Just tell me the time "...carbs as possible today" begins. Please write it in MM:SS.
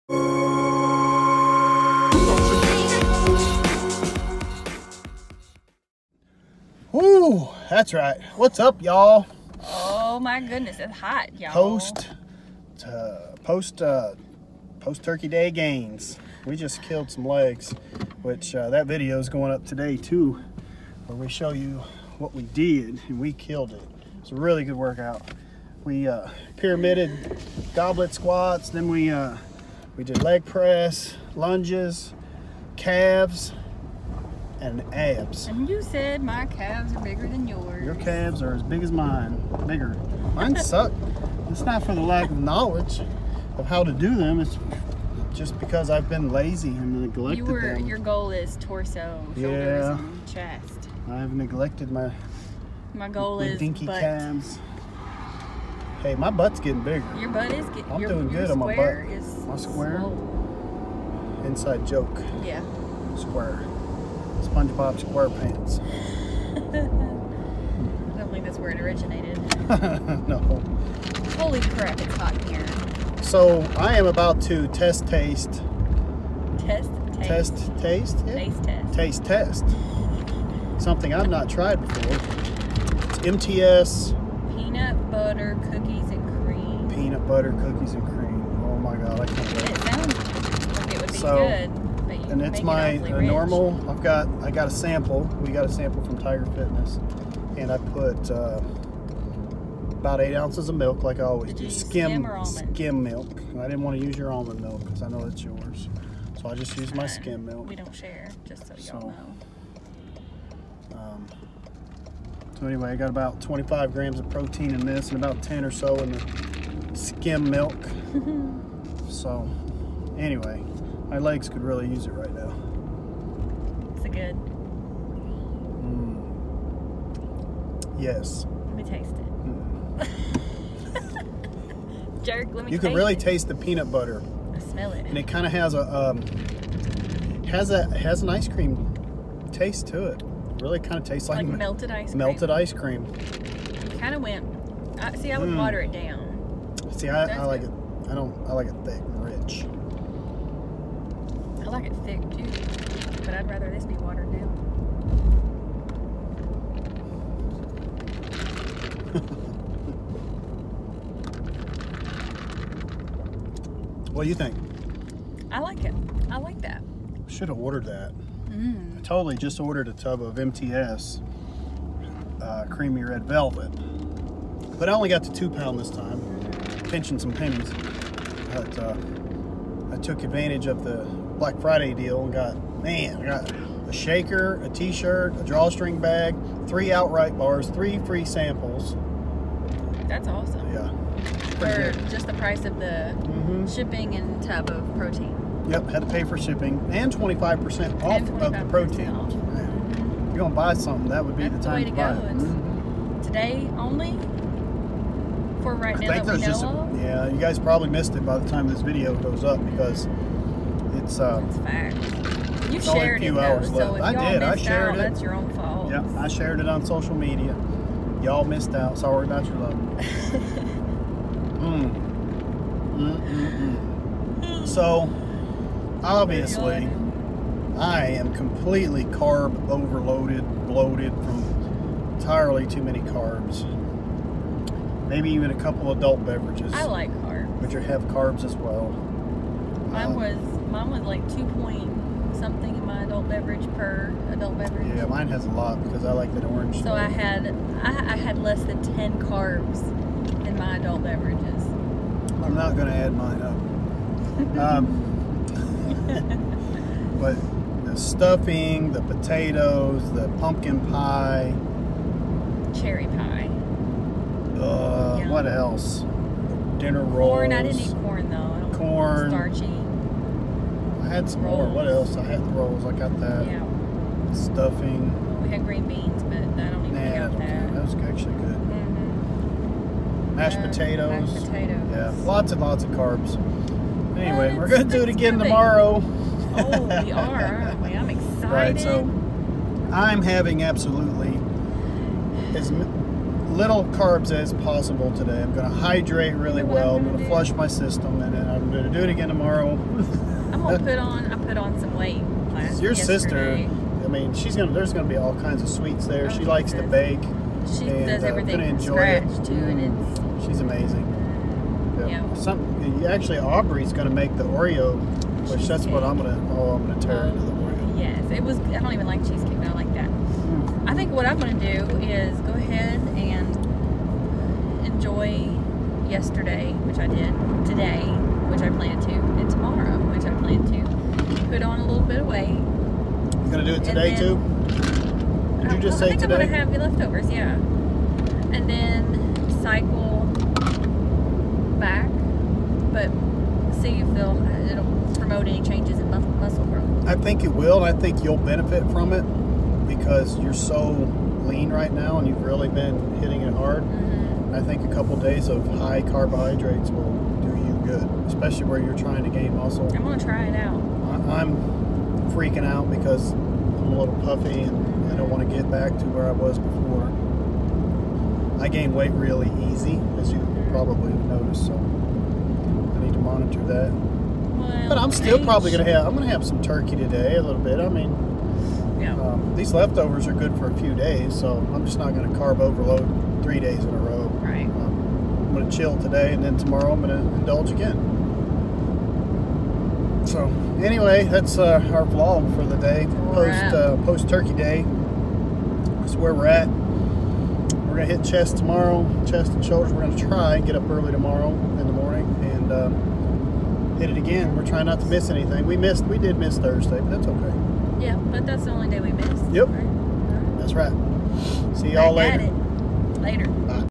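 04:53.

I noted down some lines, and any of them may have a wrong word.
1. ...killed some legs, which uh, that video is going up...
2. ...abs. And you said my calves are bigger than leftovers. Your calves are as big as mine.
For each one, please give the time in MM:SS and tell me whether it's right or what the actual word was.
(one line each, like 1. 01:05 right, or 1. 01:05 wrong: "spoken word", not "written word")
1. 00:16 right
2. 00:34 wrong: "yours", not "leftovers".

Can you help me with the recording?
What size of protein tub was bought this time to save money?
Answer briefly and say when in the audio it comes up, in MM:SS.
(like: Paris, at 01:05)
2 pound, at 02:55.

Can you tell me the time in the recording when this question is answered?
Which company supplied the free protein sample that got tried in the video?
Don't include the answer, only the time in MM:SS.
01:36.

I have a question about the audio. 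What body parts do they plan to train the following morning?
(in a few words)
Chest and shoulders.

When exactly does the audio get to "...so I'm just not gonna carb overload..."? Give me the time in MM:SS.
06:21.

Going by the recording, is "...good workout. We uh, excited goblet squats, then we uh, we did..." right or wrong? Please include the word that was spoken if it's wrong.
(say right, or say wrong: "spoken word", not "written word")
wrong: "pyramided", not "excited".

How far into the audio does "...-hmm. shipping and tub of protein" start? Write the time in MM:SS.
03:13.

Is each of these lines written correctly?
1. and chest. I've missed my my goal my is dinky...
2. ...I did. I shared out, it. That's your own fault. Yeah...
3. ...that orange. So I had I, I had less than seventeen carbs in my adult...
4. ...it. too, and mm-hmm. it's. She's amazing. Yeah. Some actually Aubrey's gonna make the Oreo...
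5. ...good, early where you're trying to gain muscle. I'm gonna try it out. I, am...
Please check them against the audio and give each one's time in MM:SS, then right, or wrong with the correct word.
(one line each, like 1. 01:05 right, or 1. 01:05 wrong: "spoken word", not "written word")
1. 00:49 wrong: "neglected", not "missed"
2. 03:34 right
3. 04:06 wrong: "ten", not "seventeen"
4. 05:09 right
5. 05:57 wrong: "especially", not "early".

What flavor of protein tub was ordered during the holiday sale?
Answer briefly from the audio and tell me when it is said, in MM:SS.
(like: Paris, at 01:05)
Creamy red velvet, at 02:52.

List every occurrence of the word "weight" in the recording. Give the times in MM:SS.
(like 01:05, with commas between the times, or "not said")
05:01, 05:32, 06:08.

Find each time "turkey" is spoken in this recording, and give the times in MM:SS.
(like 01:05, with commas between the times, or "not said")
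00:15, 06:16, 06:34.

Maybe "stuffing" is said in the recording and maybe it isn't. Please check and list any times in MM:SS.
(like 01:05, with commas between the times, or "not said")
04:17, 04:34.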